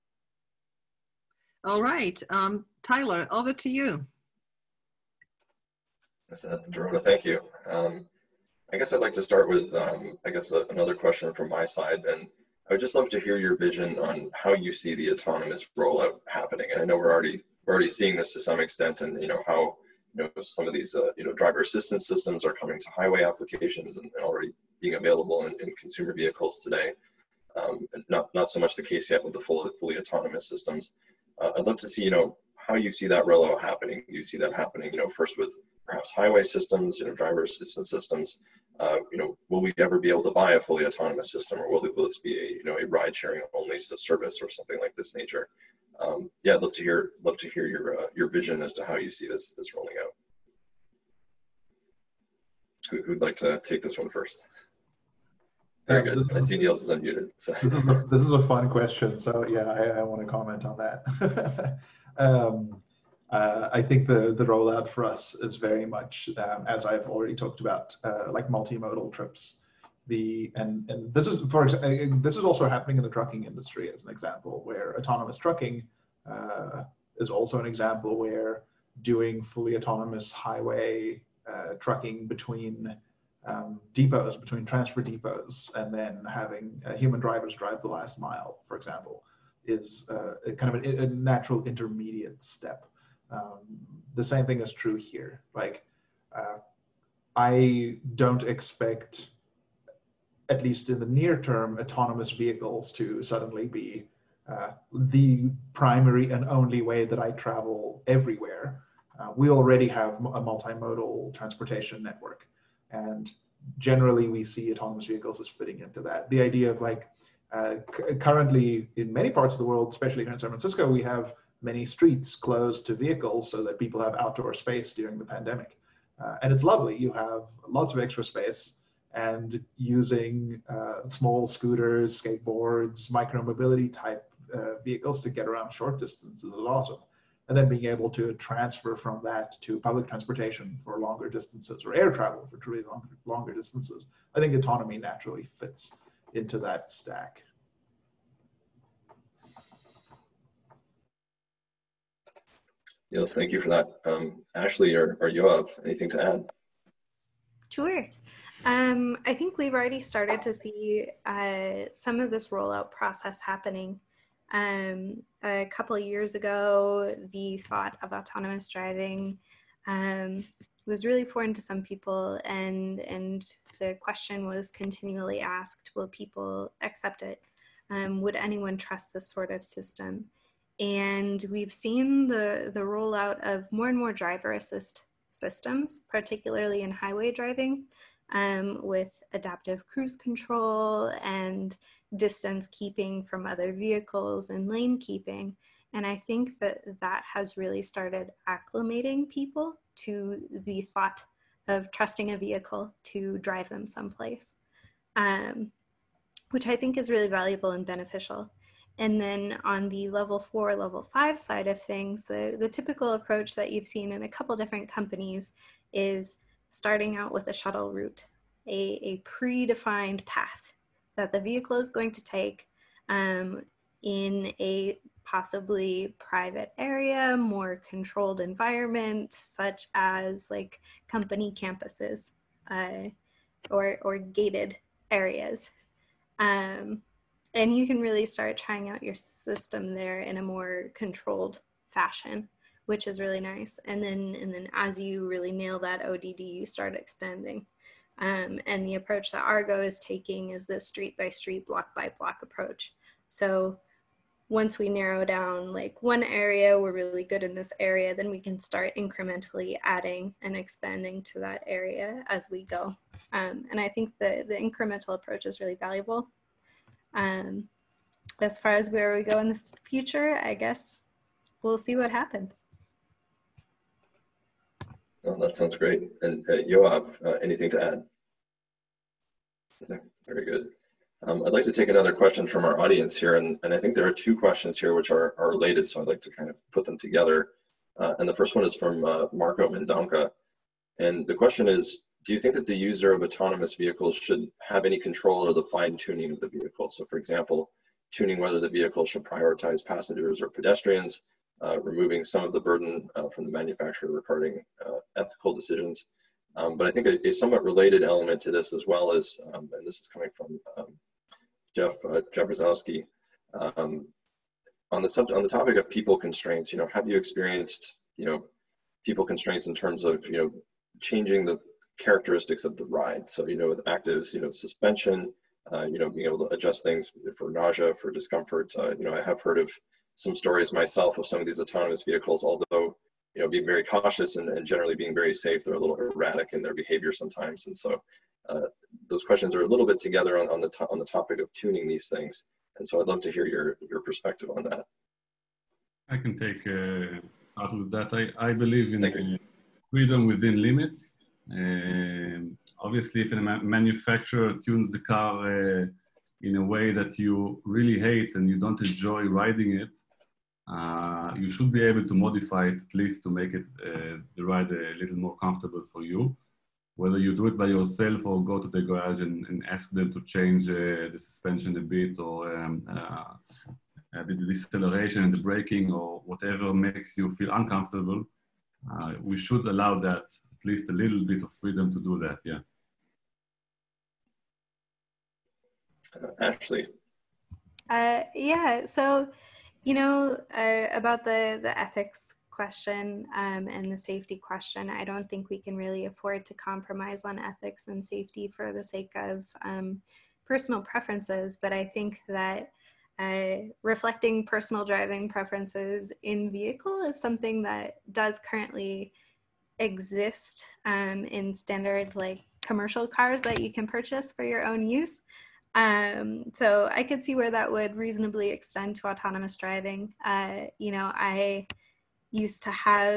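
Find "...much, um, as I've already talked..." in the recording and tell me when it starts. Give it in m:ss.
1:05.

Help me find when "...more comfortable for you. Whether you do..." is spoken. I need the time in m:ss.
6:05.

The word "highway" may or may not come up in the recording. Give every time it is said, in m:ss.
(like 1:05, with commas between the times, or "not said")
0:22, 0:36, 1:20, 3:06.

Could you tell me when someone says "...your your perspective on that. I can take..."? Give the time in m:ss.
5:43.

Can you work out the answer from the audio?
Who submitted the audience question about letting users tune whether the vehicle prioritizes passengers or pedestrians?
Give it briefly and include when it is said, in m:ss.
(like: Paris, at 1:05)
Marco Mendonca, at 4:49.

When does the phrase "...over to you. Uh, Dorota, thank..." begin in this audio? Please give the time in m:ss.
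0:03.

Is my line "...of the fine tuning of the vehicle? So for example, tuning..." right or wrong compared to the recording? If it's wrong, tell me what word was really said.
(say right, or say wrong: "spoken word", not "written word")
right.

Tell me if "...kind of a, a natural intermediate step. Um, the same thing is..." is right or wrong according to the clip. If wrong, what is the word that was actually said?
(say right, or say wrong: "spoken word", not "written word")
right.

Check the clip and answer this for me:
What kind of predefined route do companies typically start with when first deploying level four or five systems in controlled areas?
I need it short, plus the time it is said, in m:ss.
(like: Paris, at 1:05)
a shuttle route, at 3:37.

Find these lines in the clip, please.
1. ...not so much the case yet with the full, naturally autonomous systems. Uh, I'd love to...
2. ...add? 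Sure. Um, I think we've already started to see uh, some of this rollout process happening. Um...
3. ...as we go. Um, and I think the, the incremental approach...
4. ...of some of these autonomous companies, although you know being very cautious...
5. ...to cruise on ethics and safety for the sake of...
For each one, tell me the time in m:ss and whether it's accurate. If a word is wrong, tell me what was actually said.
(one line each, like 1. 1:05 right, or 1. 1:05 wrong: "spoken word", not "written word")
1. 0:28 wrong: "fully", not "naturally"
2. 2:36 right
3. 4:22 right
4. 5:31 wrong: "vehicles", not "companies"
5. 6:36 wrong: "compromise", not "cruise".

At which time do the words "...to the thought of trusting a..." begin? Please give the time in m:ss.
3:19.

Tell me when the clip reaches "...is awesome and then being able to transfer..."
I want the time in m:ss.
2:16.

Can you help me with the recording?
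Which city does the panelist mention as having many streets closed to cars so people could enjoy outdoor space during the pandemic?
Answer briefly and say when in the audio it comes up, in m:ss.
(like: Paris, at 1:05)
San Francisco, at 2:00.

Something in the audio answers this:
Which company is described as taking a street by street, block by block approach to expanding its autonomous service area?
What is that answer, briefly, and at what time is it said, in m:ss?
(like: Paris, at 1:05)
Argo, at 4:09.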